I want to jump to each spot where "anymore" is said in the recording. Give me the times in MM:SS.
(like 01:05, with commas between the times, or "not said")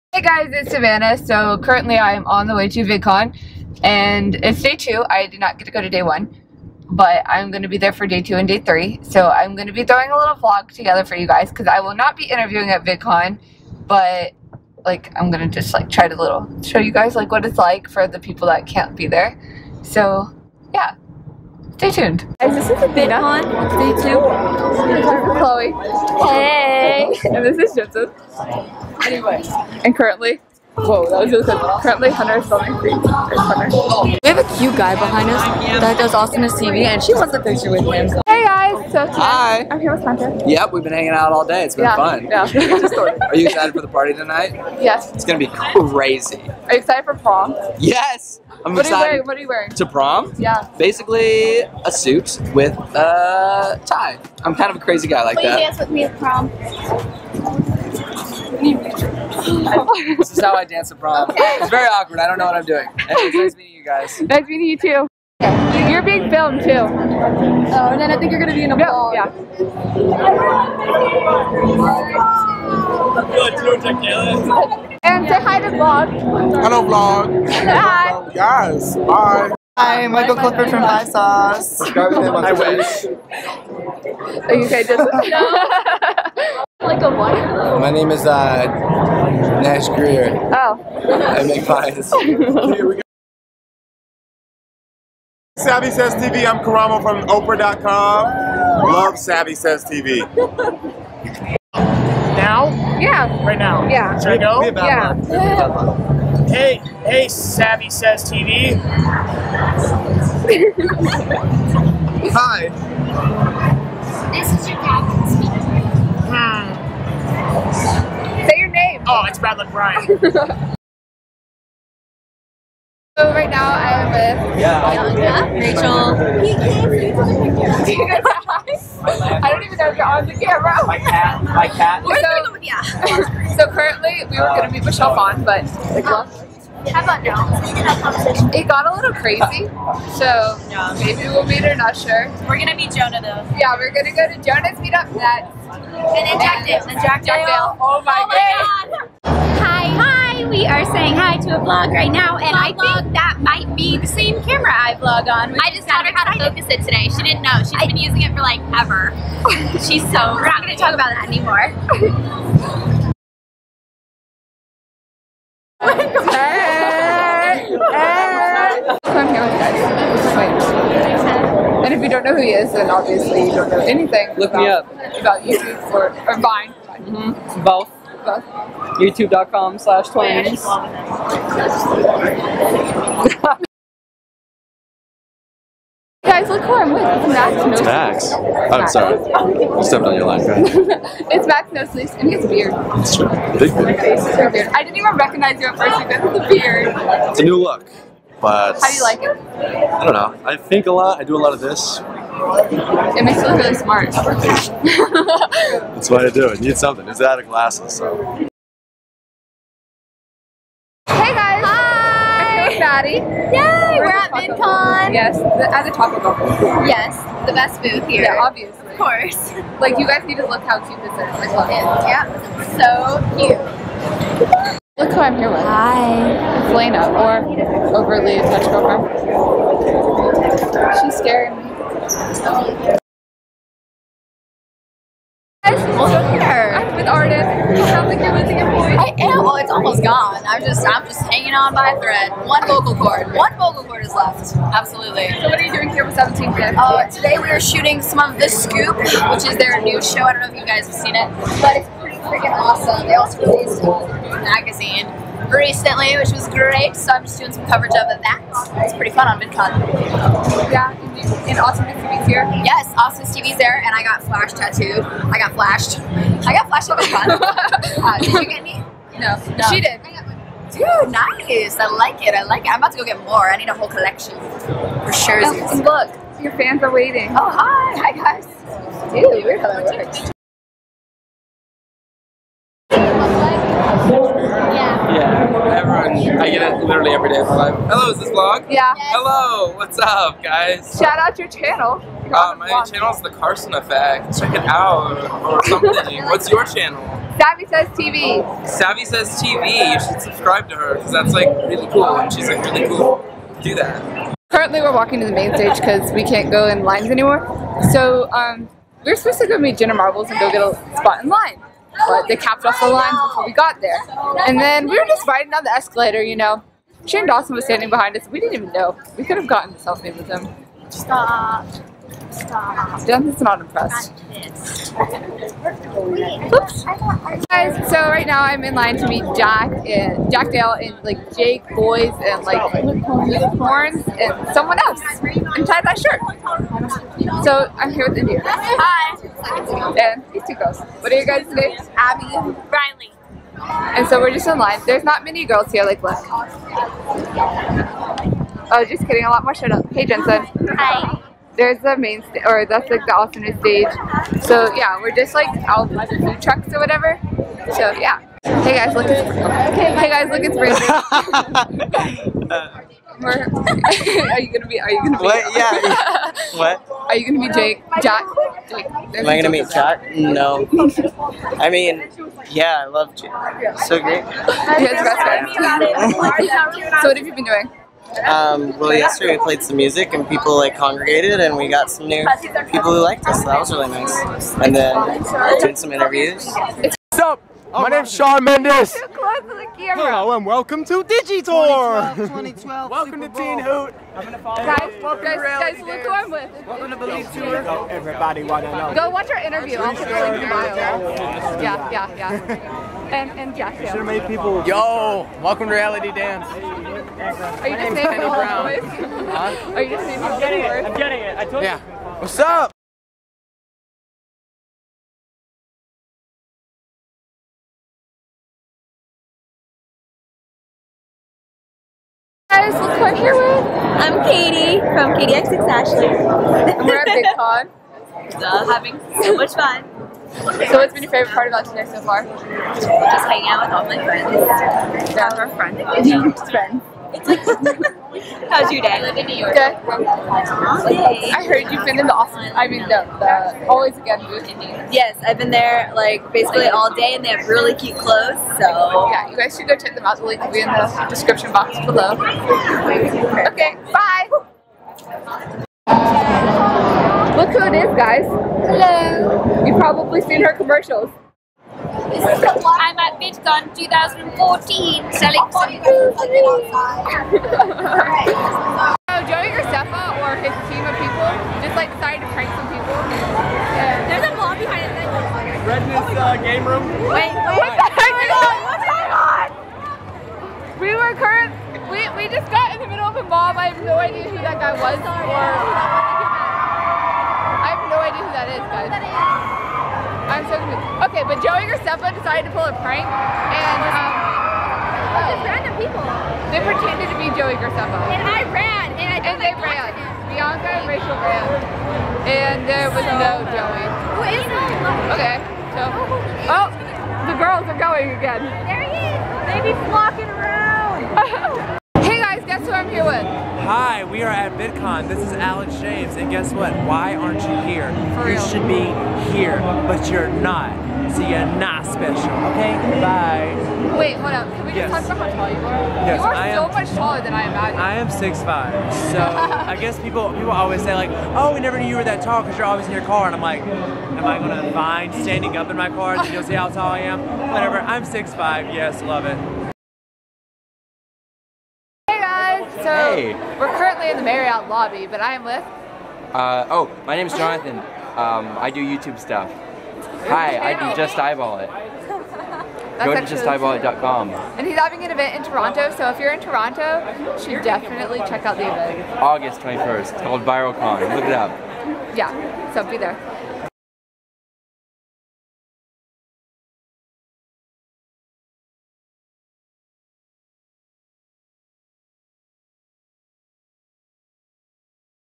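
02:41, 05:07.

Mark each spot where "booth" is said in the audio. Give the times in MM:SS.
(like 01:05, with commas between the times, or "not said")
03:37, 07:24.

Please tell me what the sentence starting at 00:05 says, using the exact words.
I did not get to go to day one, but I'm going to be there for day two and day three.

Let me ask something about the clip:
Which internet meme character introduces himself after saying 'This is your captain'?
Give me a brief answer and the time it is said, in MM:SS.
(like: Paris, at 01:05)
Bad Luck Brian, at 01:59.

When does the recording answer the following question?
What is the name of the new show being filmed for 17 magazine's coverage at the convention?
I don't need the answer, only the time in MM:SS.
04:08.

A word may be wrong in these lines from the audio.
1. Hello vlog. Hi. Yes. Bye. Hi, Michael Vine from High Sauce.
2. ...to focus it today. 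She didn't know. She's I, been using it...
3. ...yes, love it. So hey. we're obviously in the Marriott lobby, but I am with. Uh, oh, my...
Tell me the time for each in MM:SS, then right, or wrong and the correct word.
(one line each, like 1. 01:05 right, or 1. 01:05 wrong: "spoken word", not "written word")
1. 01:16 wrong: "Clifford", not "Vine"
2. 02:36 right
3. 08:58 wrong: "currently", not "obviously".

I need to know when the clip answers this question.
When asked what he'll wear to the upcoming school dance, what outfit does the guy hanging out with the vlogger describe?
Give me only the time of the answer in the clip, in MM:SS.
00:51.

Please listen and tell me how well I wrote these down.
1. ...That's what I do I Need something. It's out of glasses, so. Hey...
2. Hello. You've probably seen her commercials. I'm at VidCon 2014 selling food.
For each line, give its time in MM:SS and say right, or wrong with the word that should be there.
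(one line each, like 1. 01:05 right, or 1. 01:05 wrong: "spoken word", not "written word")
1. 03:24 right
2. 07:38 right.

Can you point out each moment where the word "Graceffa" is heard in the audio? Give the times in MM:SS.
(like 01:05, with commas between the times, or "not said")
07:49, 08:11, 08:17.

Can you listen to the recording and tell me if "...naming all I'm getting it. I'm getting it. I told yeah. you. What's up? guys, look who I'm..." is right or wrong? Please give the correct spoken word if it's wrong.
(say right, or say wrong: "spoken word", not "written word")
right.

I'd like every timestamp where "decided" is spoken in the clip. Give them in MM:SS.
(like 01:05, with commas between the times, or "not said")
07:51, 08:12.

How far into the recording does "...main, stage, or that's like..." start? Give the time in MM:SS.
05:51.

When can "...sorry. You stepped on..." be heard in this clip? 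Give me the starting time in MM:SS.
03:08.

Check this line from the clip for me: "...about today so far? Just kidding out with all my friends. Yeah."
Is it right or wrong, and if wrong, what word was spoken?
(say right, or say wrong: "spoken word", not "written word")
wrong: "hanging", not "kidding".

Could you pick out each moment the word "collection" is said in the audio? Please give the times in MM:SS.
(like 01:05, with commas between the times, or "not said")
04:33.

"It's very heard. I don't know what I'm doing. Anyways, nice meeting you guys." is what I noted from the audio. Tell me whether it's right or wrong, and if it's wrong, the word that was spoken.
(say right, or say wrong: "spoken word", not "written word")
wrong: "awkward", not "heard".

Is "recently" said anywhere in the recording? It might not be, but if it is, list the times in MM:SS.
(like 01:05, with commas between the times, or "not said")
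04:15.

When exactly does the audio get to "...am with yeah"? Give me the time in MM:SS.
02:04.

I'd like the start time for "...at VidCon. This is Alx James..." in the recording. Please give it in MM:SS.
08:34.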